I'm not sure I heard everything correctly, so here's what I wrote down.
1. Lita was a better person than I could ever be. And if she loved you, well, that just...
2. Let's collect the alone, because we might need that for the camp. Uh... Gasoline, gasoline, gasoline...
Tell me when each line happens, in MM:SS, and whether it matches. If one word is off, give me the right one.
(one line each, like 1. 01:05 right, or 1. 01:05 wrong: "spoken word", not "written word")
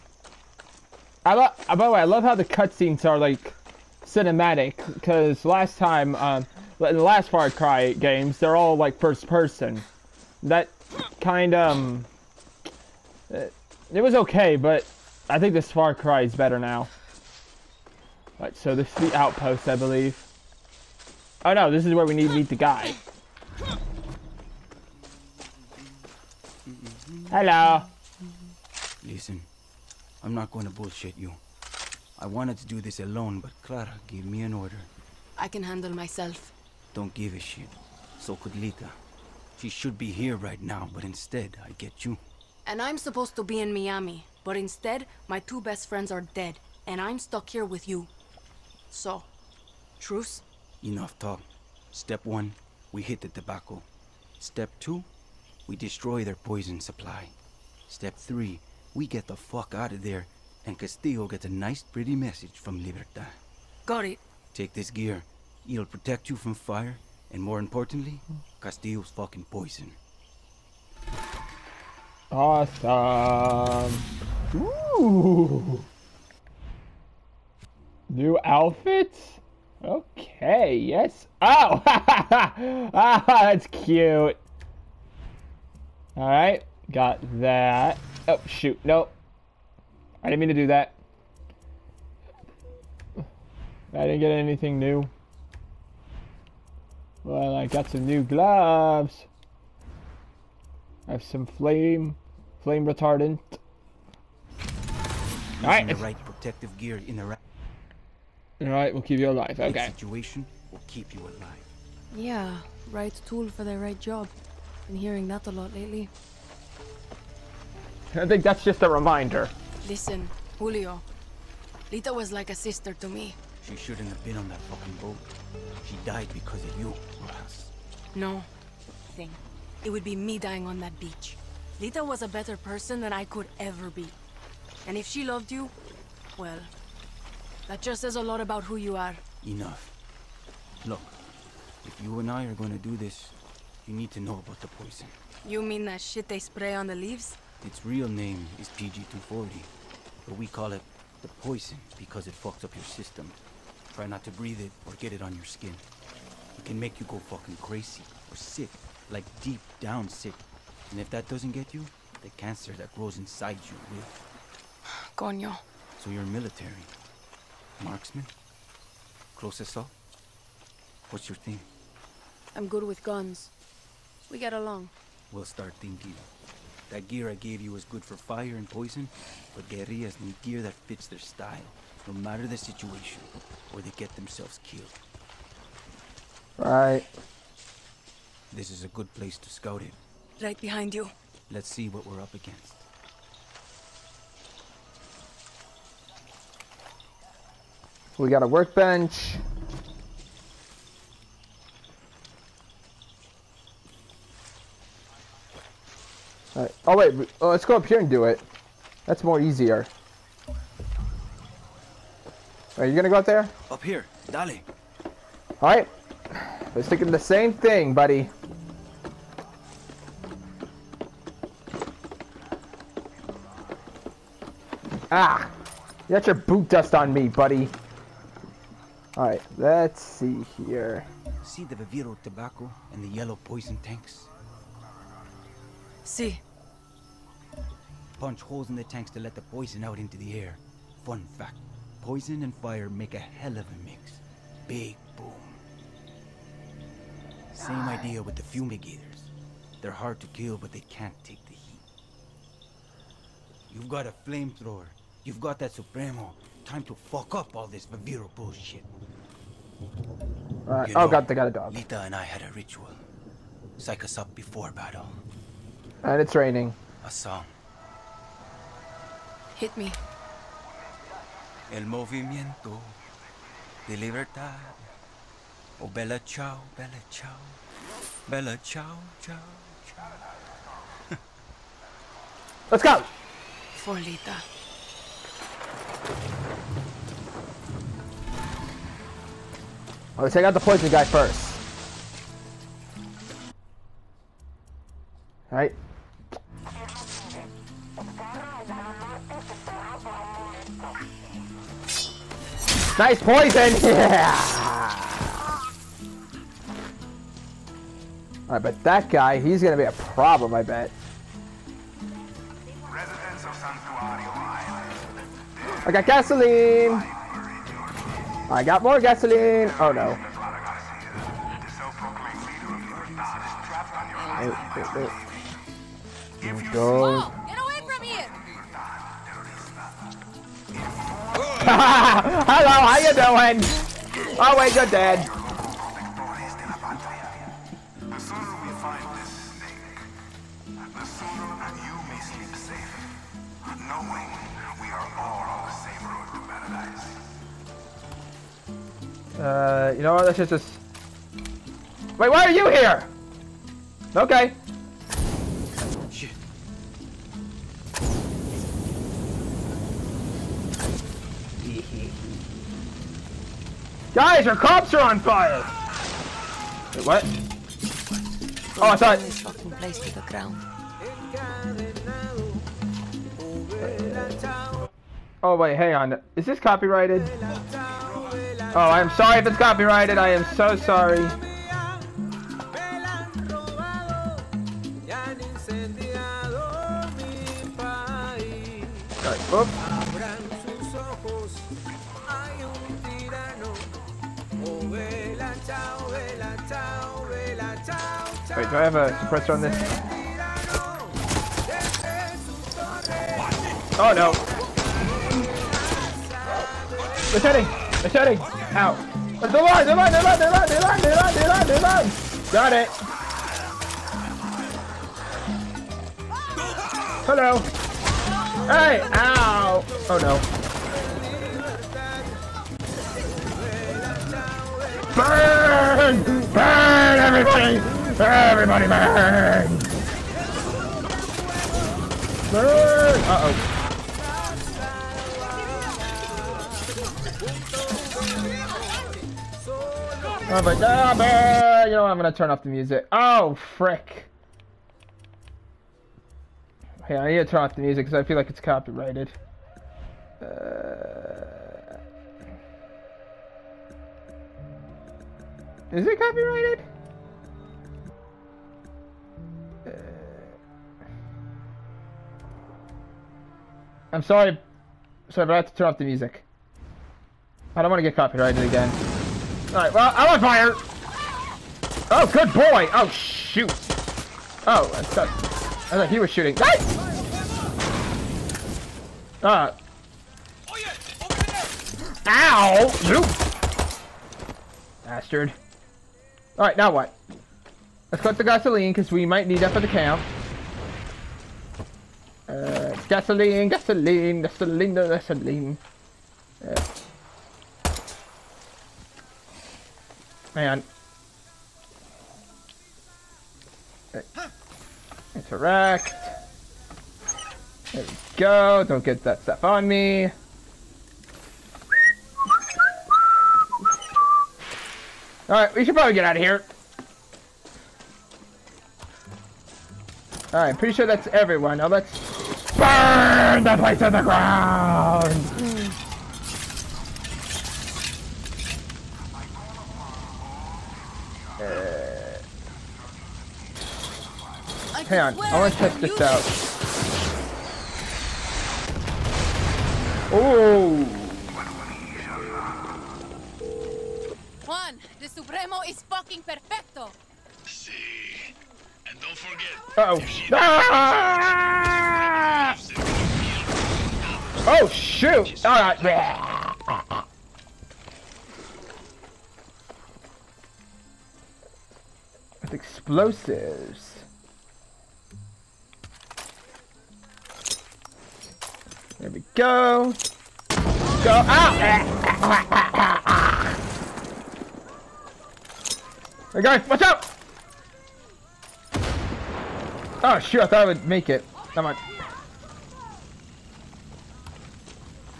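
1. 02:11 right
2. 08:08 wrong: "gasoline", not "alone".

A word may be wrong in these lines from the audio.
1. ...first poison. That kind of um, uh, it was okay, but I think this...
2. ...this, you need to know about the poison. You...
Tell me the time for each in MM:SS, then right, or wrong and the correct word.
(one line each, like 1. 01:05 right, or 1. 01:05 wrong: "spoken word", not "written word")
1. 00:08 wrong: "person", not "poison"
2. 02:22 right.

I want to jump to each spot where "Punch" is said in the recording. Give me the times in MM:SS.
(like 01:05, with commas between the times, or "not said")
03:58.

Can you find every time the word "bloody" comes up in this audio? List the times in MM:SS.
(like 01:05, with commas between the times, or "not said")
not said.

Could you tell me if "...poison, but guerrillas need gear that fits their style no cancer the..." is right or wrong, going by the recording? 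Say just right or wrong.
wrong.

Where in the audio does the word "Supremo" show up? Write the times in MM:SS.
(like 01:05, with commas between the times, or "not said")
04:15, 09:05.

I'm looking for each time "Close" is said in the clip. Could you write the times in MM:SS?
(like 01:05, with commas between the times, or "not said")
02:49.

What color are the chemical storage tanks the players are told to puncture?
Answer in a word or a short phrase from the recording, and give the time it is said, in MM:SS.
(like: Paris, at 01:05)
Yellow, at 03:53.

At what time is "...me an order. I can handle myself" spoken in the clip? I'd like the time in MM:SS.
00:34.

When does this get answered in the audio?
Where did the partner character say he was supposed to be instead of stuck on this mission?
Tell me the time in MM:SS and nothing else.
00:43.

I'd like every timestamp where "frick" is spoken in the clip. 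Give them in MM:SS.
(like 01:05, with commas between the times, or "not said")
07:23.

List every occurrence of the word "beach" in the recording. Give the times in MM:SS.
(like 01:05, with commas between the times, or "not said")
02:10.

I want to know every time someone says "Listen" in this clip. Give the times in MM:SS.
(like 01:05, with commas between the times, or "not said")
00:29, 01:59.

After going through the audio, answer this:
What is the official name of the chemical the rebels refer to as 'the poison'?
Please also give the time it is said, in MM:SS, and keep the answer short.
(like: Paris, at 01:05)
PG-240, at 02:28.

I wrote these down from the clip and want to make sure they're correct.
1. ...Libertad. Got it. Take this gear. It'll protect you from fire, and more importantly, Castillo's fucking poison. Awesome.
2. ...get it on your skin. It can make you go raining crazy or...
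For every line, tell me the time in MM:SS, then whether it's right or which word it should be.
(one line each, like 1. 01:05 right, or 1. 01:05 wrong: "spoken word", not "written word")
1. 01:02 right
2. 02:34 wrong: "fucking", not "raining".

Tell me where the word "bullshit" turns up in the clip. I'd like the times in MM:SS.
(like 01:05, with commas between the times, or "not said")
00:30, 04:18.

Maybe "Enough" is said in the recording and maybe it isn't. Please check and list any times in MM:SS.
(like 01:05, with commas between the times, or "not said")
00:50, 02:19.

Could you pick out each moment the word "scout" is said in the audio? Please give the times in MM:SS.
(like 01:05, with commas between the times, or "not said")
03:09.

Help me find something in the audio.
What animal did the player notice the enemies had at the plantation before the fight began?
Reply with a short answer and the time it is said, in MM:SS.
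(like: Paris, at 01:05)
A dog, at 04:21.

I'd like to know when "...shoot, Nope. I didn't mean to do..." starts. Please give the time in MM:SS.
01:28.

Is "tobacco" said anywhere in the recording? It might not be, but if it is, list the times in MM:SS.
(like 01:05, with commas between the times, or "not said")
00:53, 03:52.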